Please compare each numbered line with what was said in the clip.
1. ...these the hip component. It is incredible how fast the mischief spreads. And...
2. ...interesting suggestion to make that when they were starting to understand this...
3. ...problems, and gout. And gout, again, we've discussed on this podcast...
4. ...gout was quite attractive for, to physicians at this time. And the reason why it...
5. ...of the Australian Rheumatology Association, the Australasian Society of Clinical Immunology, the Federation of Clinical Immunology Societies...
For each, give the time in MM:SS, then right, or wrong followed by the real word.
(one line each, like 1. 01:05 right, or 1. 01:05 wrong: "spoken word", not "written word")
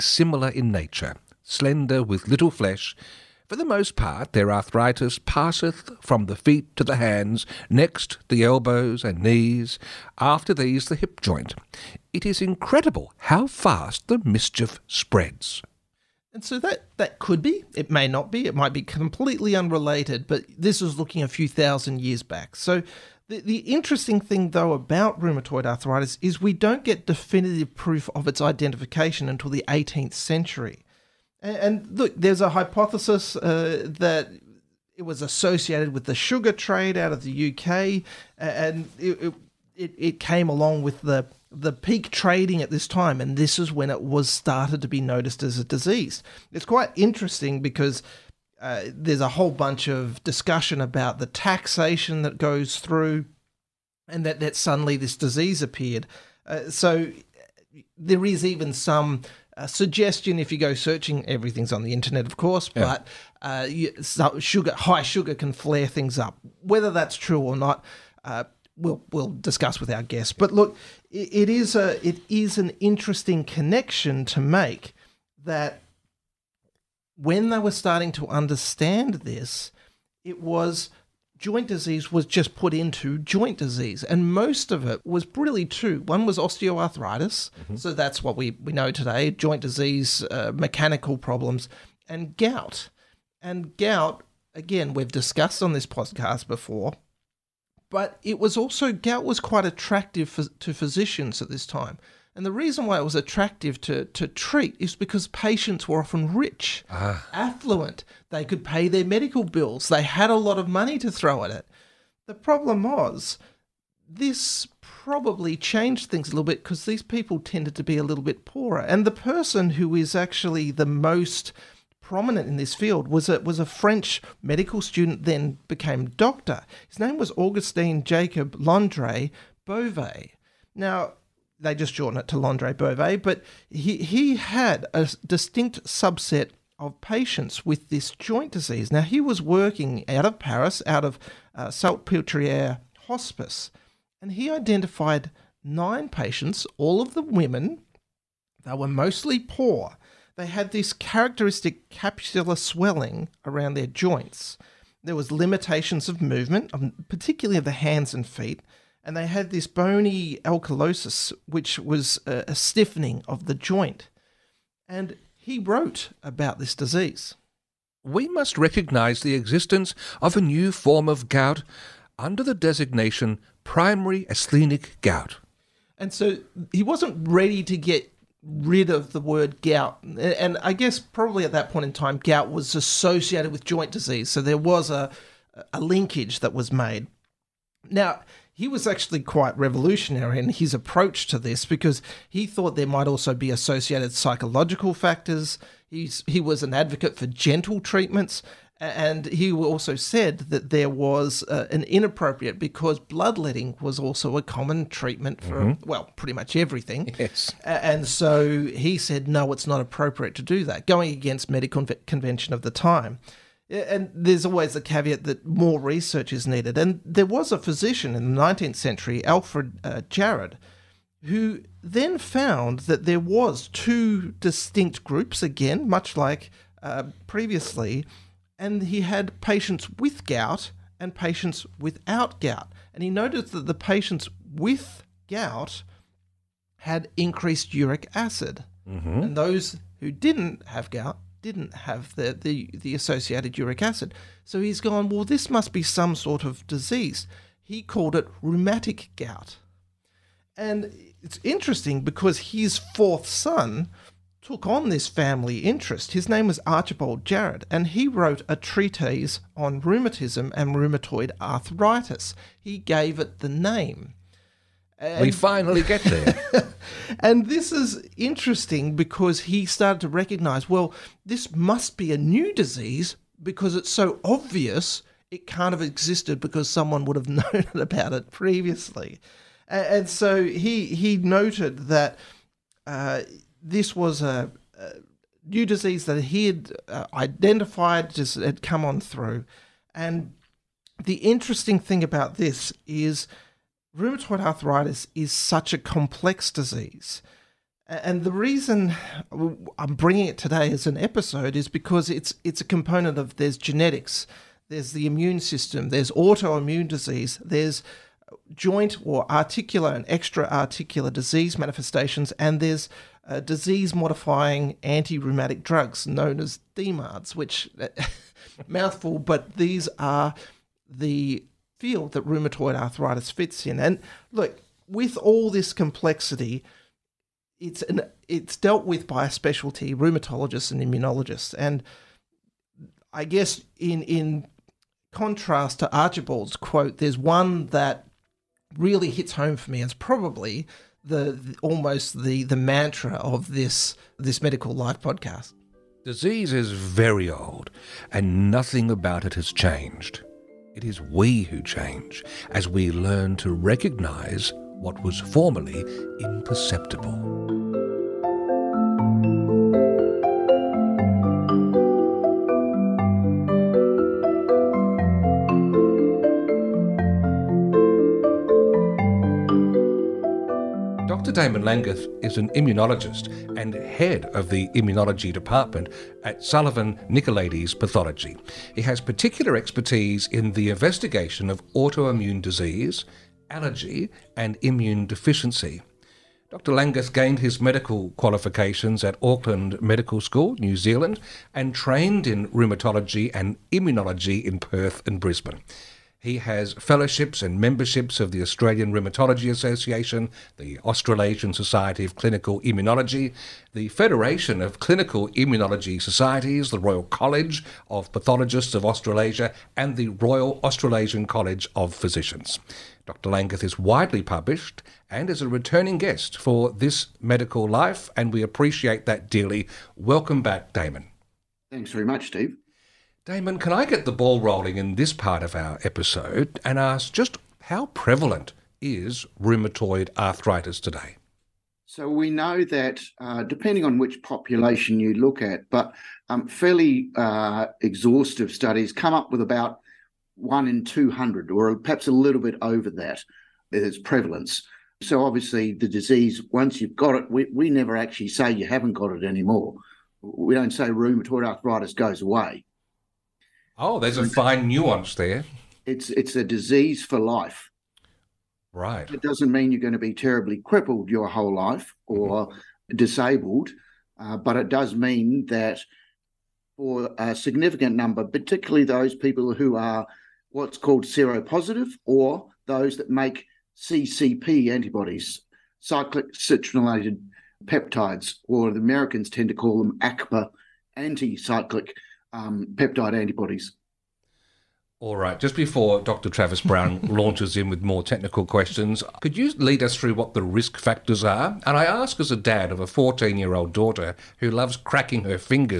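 1. 00:10 wrong: "joint", not "component"
2. 01:12 wrong: "connection", not "suggestion"
3. 01:31 right
4. 01:38 right
5. 06:38 right.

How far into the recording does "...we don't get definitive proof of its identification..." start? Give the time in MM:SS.
00:26.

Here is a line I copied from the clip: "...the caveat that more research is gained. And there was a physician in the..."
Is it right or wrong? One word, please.
wrong.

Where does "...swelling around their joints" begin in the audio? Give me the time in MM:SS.
02:32.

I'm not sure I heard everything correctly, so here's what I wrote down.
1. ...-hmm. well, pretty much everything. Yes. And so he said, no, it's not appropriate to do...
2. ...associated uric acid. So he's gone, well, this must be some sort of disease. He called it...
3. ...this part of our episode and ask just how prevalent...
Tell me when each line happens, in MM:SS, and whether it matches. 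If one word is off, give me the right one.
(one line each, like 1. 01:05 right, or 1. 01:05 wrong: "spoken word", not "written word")
1. 03:25 right
2. 04:02 right
3. 07:04 right.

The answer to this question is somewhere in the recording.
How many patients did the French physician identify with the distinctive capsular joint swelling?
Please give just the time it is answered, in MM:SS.
02:25.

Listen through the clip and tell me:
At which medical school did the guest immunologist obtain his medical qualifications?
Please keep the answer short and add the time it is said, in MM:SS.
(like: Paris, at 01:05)
Auckland Medical School, at 06:29.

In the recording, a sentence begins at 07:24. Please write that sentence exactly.
So obviously the disease, once you've got it, we, we never actually say you haven't got it anymore.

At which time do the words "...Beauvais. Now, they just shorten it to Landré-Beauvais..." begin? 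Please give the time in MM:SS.
02:09.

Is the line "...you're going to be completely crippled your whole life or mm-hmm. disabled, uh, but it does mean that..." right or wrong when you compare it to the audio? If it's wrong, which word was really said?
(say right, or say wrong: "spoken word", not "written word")
wrong: "terribly", not "completely".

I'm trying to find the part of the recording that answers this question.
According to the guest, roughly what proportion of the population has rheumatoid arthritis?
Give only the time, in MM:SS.
07:20.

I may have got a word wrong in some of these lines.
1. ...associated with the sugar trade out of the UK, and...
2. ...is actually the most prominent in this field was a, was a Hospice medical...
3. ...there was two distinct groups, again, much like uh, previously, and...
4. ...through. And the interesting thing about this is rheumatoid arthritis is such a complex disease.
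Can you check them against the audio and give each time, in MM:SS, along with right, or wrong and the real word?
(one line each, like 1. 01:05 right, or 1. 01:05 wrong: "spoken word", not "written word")
1. 00:35 right
2. 01:59 wrong: "French", not "Hospice"
3. 03:43 right
4. 04:48 right.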